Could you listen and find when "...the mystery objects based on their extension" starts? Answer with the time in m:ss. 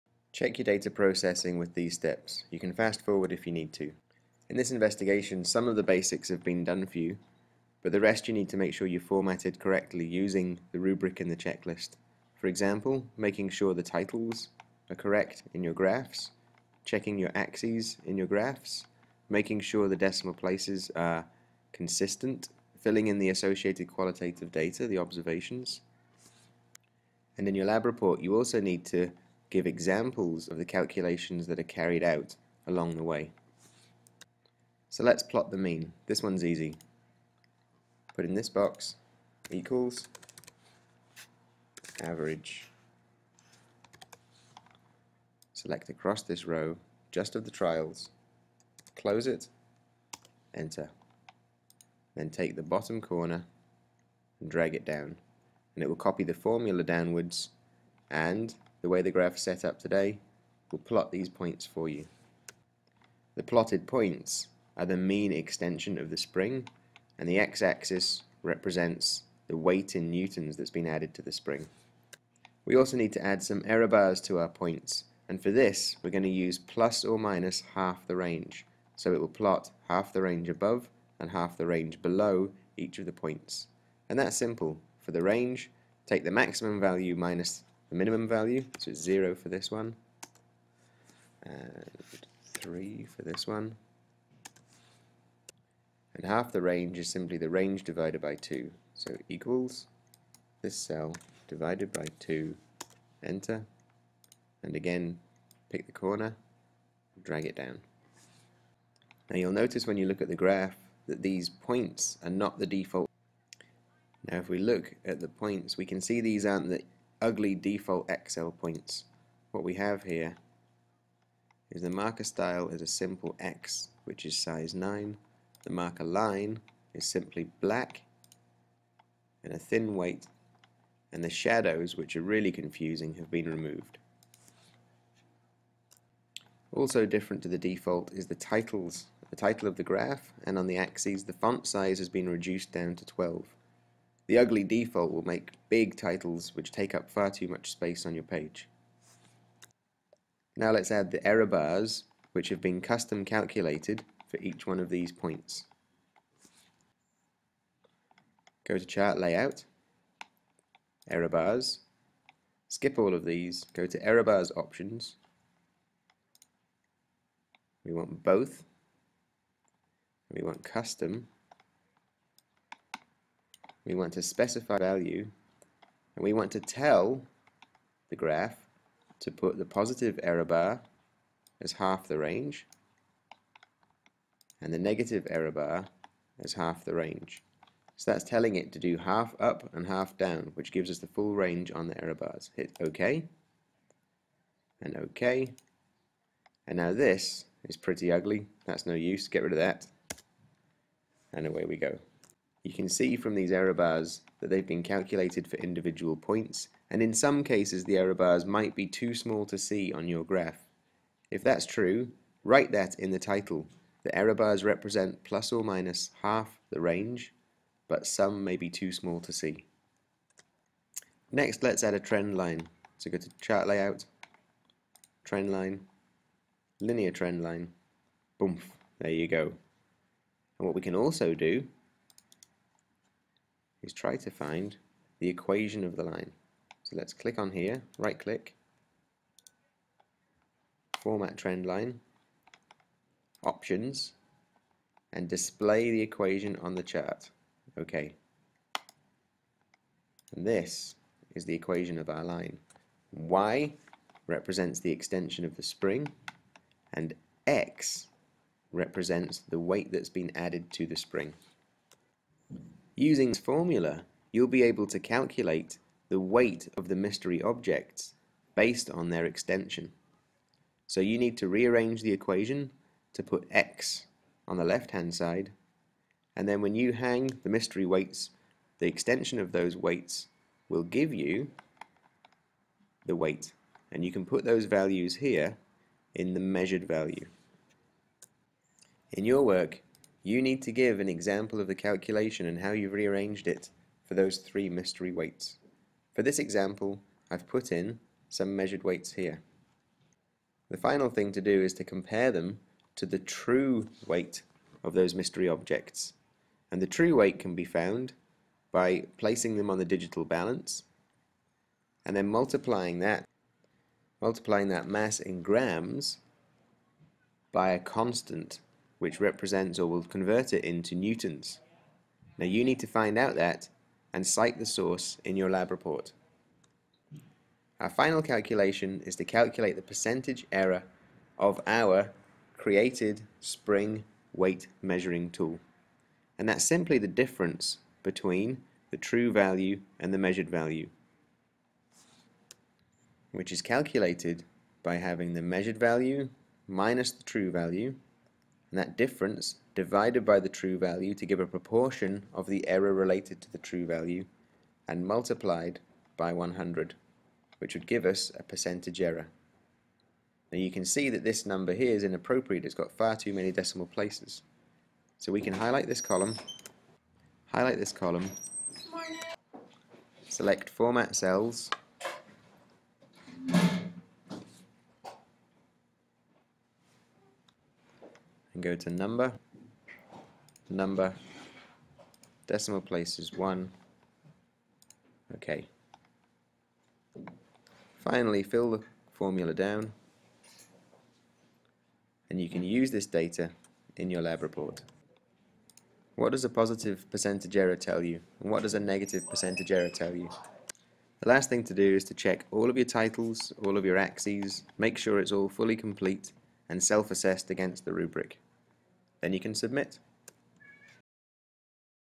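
4:26.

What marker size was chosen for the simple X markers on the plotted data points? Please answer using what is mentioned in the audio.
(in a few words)
9.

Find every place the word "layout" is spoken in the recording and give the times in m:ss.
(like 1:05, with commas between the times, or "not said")
2:39, 3:43.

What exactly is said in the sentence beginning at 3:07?
So that's telling it to do half up and half down, which gives us the full range on the error bars.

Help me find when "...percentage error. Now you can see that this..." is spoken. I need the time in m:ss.
5:58.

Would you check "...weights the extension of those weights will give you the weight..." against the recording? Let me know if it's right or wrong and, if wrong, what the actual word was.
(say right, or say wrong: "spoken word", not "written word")
right.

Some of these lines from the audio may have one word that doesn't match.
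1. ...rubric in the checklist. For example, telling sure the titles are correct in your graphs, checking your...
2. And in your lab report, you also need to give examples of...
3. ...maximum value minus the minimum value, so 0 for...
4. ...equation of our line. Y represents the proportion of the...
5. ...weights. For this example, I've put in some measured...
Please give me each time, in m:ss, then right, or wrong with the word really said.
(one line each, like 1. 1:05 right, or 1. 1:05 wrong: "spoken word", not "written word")
1. 0:10 wrong: "making", not "telling"
2. 0:27 right
3. 1:26 right
4. 4:11 wrong: "extension", not "proportion"
5. 4:55 right.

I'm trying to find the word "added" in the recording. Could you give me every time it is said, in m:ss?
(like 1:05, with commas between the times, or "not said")
1:10, 4:20.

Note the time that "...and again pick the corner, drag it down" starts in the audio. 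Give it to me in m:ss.
1:44.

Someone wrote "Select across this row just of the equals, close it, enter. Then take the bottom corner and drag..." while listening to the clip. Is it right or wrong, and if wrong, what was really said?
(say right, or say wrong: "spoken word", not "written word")
wrong: "trials", not "equals".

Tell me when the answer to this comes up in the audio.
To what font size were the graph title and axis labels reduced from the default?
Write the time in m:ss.
2:23.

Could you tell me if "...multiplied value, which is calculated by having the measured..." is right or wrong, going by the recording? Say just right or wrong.
wrong.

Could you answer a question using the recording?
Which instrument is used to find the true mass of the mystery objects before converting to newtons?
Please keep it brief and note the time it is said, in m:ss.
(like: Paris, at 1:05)
Digital balance, at 5:09.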